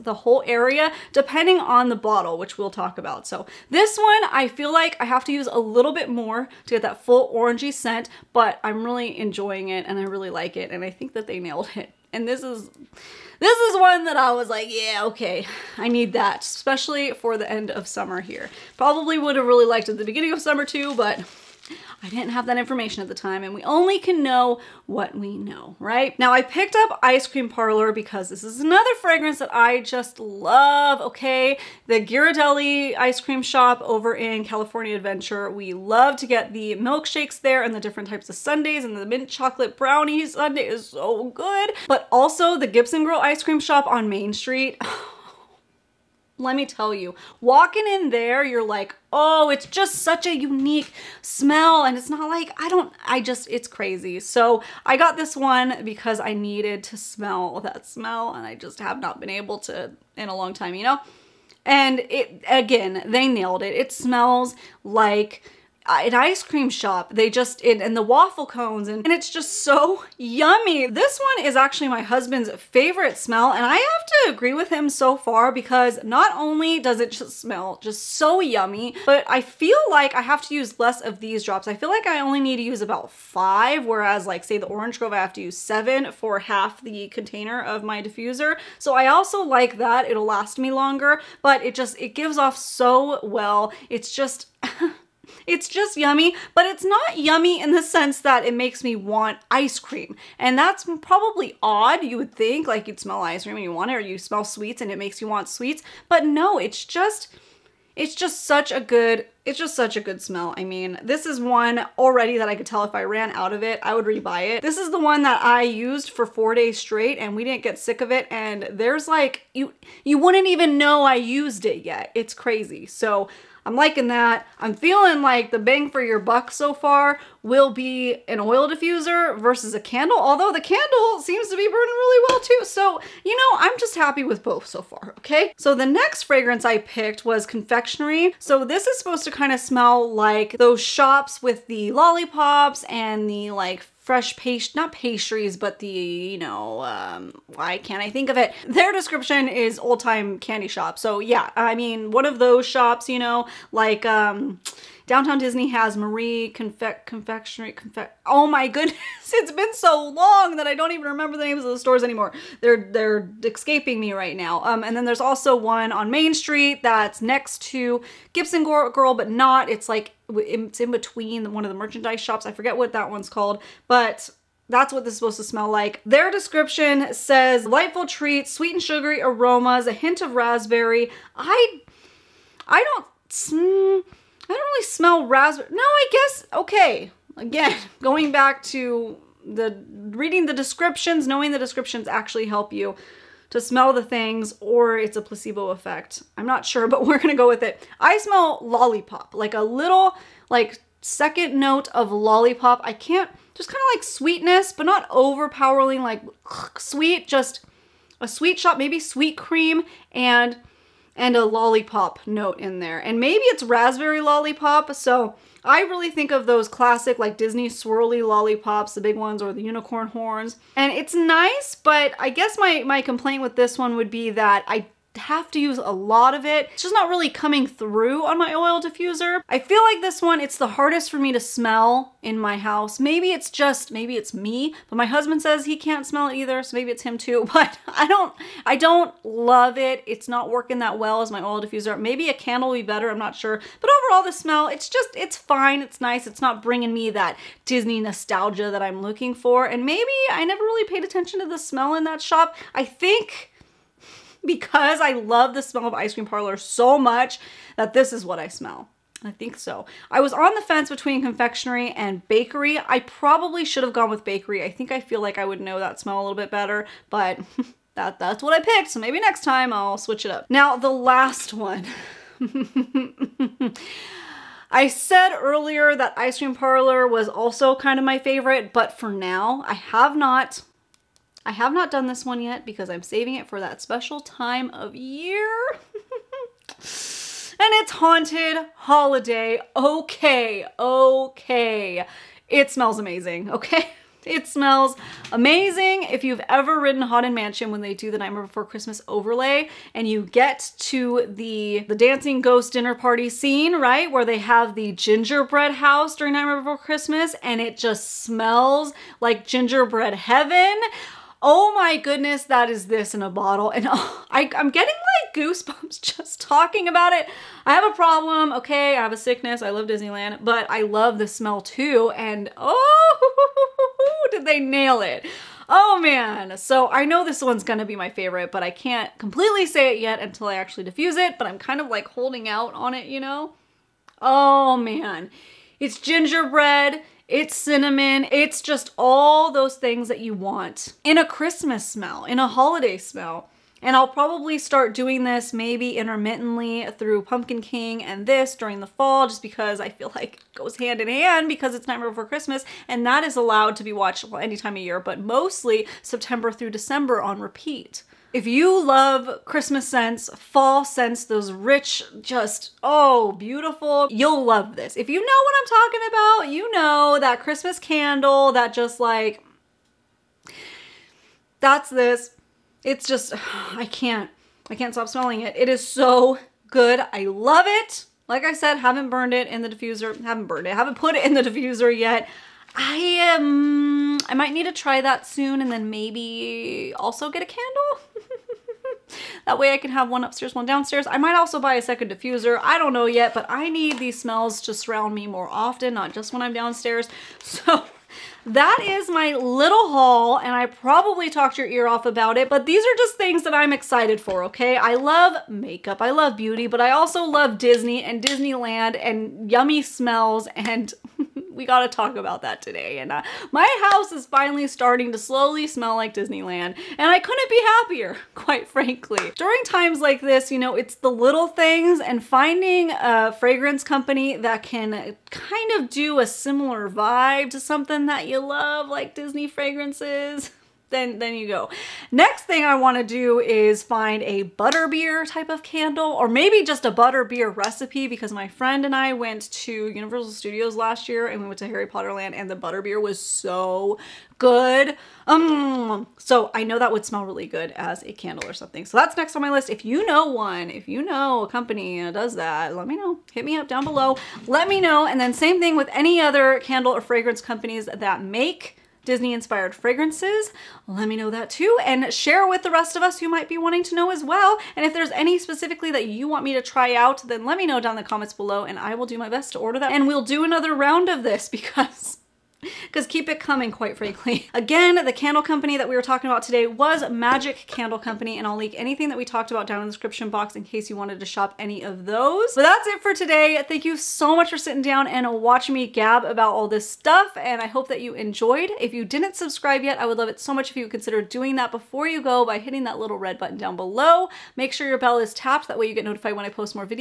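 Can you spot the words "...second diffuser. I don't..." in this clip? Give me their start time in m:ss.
6:31.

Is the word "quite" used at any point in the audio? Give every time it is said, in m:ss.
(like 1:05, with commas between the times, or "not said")
6:58, 7:53.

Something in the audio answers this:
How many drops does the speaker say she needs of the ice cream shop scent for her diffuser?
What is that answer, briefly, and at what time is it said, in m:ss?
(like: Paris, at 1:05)
5, at 1:23.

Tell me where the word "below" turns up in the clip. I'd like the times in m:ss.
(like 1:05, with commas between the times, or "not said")
7:33, 7:48, 8:13.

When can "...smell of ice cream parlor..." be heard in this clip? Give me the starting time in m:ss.
4:15.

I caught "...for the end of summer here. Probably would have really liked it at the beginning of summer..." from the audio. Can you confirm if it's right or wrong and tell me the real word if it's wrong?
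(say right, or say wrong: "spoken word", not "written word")
right.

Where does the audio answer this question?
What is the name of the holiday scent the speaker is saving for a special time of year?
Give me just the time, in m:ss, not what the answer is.
4:47.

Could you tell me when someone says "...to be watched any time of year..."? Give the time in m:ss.
5:53.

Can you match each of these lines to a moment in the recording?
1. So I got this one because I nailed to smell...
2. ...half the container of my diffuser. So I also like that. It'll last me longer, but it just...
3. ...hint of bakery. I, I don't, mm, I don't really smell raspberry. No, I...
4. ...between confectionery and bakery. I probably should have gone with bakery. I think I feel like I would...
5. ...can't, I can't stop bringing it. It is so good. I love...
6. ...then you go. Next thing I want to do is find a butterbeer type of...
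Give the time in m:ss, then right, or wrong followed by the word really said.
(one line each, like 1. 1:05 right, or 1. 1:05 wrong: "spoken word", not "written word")
1. 0:54 wrong: "needed", not "nailed"
2. 1:26 right
3. 2:59 wrong: "raspberry", not "bakery"
4. 4:20 right
5. 6:13 wrong: "smelling", not "bringing"
6. 7:11 right.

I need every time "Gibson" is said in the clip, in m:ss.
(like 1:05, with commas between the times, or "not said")
0:42, 2:48.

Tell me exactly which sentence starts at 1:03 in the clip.
It smells like uh, an ice cream shop.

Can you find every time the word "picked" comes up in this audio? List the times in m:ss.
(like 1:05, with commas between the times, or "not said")
0:26, 2:16, 4:28.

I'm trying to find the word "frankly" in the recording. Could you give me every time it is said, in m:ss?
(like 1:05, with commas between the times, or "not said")
6:58, 7:53.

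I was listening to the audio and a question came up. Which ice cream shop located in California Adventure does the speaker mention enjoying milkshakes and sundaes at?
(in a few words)
Ghirardelli.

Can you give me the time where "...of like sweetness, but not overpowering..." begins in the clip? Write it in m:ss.
3:23.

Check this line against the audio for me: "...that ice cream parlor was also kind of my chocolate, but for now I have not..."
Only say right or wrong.
wrong.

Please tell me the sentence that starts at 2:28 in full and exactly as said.
Their description is old time candy shop.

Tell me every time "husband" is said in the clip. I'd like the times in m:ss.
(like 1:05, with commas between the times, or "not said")
1:12, 3:55.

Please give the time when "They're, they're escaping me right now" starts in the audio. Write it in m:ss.
2:42.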